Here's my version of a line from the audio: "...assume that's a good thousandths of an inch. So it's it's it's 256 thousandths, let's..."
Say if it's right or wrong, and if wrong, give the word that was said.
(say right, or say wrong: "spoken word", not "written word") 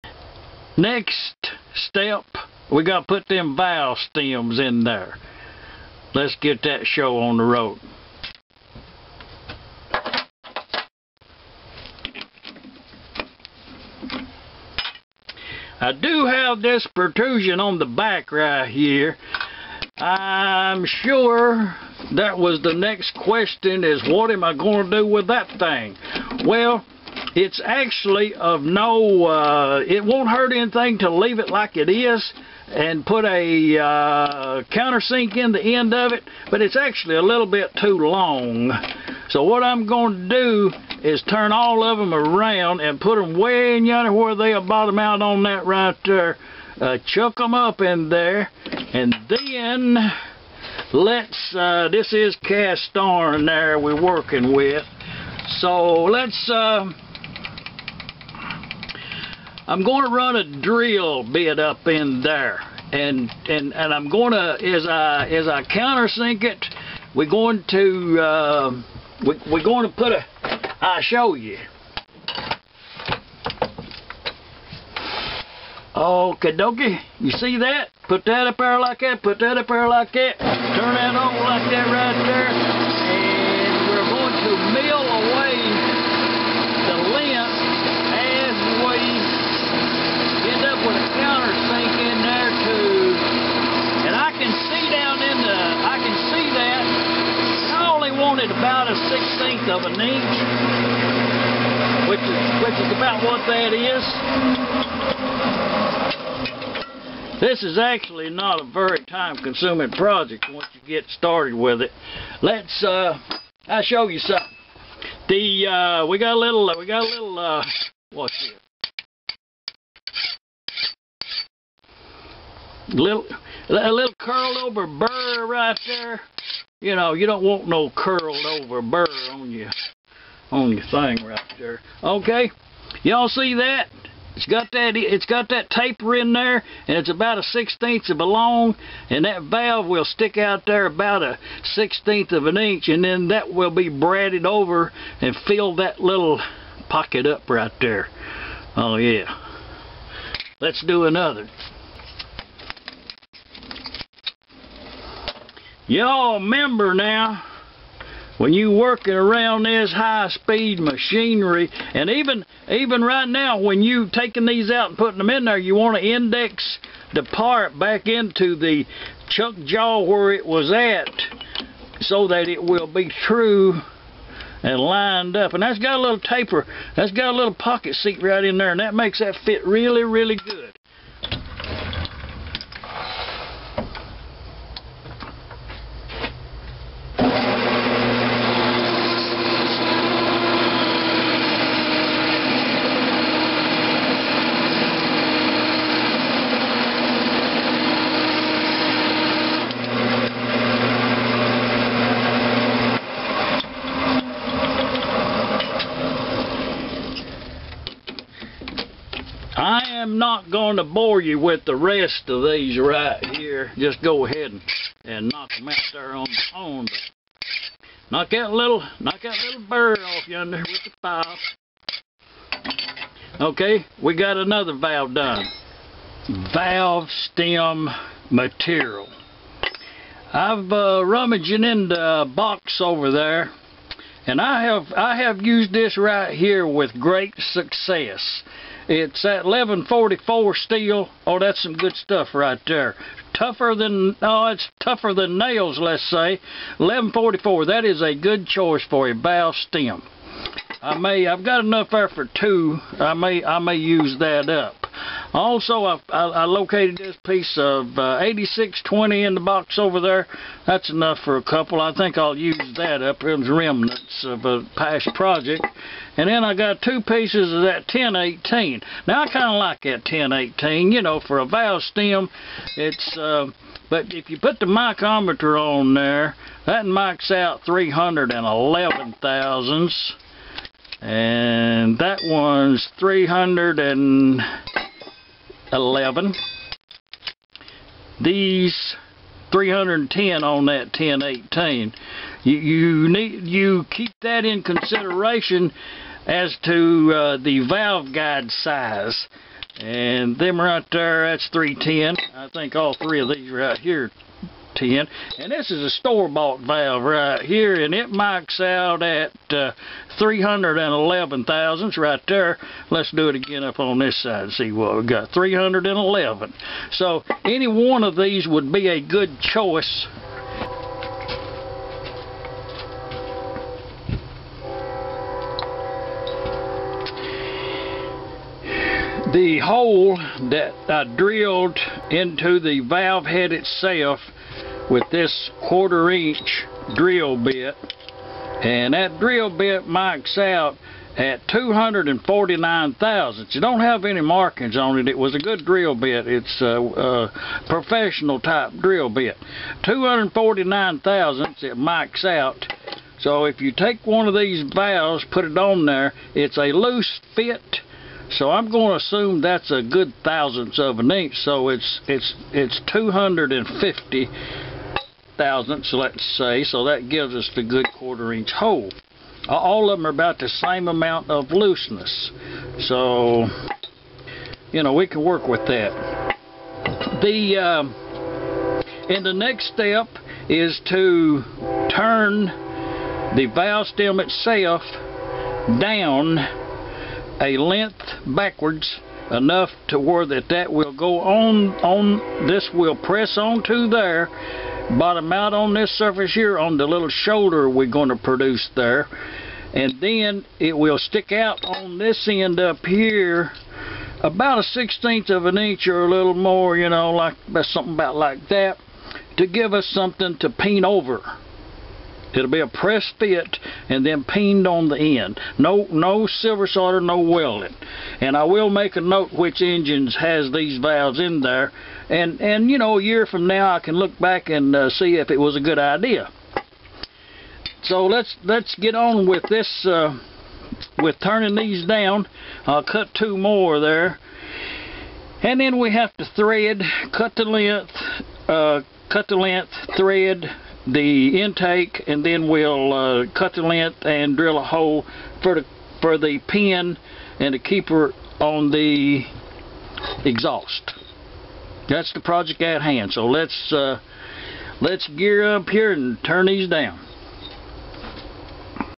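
wrong: "250", not "256".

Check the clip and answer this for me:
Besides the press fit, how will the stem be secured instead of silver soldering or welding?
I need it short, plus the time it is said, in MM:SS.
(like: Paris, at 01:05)
Peened on the end, at 06:54.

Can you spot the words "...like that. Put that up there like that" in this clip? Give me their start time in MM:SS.
01:18.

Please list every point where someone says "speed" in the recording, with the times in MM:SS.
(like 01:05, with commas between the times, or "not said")
02:39.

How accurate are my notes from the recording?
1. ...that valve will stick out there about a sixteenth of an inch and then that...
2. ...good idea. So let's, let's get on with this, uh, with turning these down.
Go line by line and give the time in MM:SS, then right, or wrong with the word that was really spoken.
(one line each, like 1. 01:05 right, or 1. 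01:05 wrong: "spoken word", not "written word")
1. 02:19 right
2. 07:05 right.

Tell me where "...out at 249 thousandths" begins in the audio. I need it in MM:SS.
05:40.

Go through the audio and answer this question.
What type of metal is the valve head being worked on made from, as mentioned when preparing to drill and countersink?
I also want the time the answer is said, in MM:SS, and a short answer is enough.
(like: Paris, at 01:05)
Cast iron, at 00:52.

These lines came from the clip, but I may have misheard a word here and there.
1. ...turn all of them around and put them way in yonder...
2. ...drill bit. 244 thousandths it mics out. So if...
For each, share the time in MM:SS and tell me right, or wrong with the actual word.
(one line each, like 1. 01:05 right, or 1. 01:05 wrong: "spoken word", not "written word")
1. 00:41 right
2. 05:48 wrong: "249", not "244".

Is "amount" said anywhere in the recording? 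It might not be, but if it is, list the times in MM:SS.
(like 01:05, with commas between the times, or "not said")
06:10.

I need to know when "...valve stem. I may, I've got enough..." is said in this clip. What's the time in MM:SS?
04:09.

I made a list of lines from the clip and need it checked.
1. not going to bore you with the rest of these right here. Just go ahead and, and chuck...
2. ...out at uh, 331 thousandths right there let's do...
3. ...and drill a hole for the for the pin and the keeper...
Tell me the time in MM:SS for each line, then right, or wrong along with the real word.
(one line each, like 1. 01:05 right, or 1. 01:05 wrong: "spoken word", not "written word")
1. 03:30 wrong: "knock", not "chuck"
2. 05:08 wrong: "311", not "331"
3. 07:24 right.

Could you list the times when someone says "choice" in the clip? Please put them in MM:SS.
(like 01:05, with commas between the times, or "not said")
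04:08, 05:19.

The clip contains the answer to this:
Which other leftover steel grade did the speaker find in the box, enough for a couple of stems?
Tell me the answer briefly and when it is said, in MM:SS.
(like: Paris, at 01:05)
8620, at 04:18.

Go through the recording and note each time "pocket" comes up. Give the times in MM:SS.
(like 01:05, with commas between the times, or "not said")
02:26, 02:57.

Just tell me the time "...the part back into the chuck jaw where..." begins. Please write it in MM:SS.
02:47.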